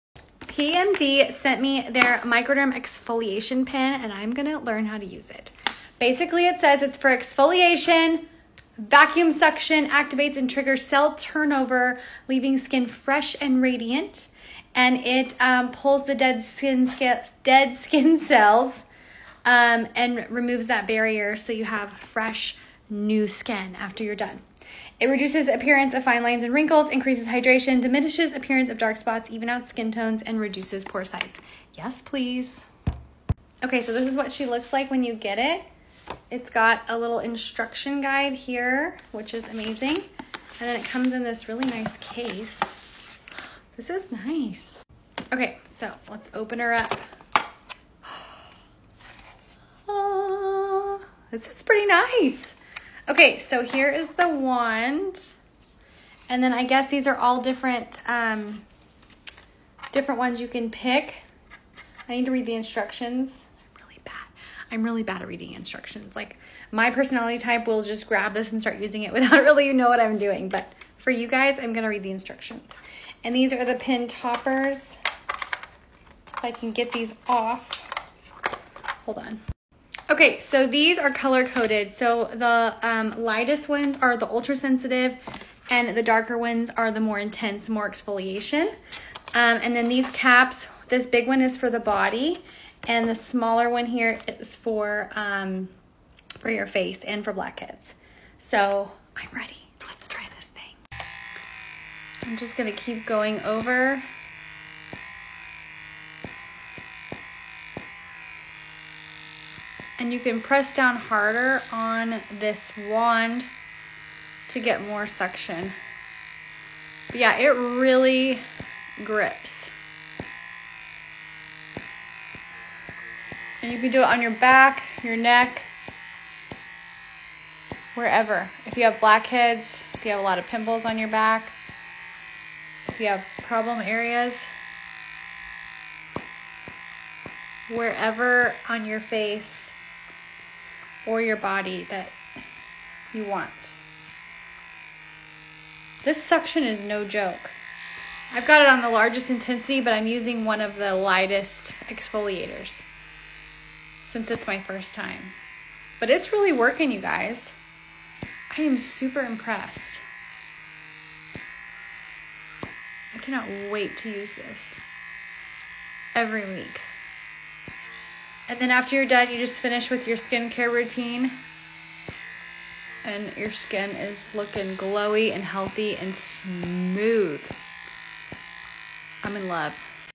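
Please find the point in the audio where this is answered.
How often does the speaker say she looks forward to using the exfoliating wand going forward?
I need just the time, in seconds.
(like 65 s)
166 s.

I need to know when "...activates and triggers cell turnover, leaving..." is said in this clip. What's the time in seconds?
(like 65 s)
9 s.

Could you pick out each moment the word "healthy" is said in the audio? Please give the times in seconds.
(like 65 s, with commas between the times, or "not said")
175 s.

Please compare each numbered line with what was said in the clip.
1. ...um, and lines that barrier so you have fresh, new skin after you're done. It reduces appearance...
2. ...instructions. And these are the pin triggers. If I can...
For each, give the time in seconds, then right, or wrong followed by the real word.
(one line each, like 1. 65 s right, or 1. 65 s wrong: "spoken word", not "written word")
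1. 19 s wrong: "removes", not "lines"
2. 72 s wrong: "toppers", not "triggers".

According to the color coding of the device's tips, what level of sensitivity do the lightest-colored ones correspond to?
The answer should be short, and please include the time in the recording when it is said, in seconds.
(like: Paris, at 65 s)
ultra sensitive, at 84 s.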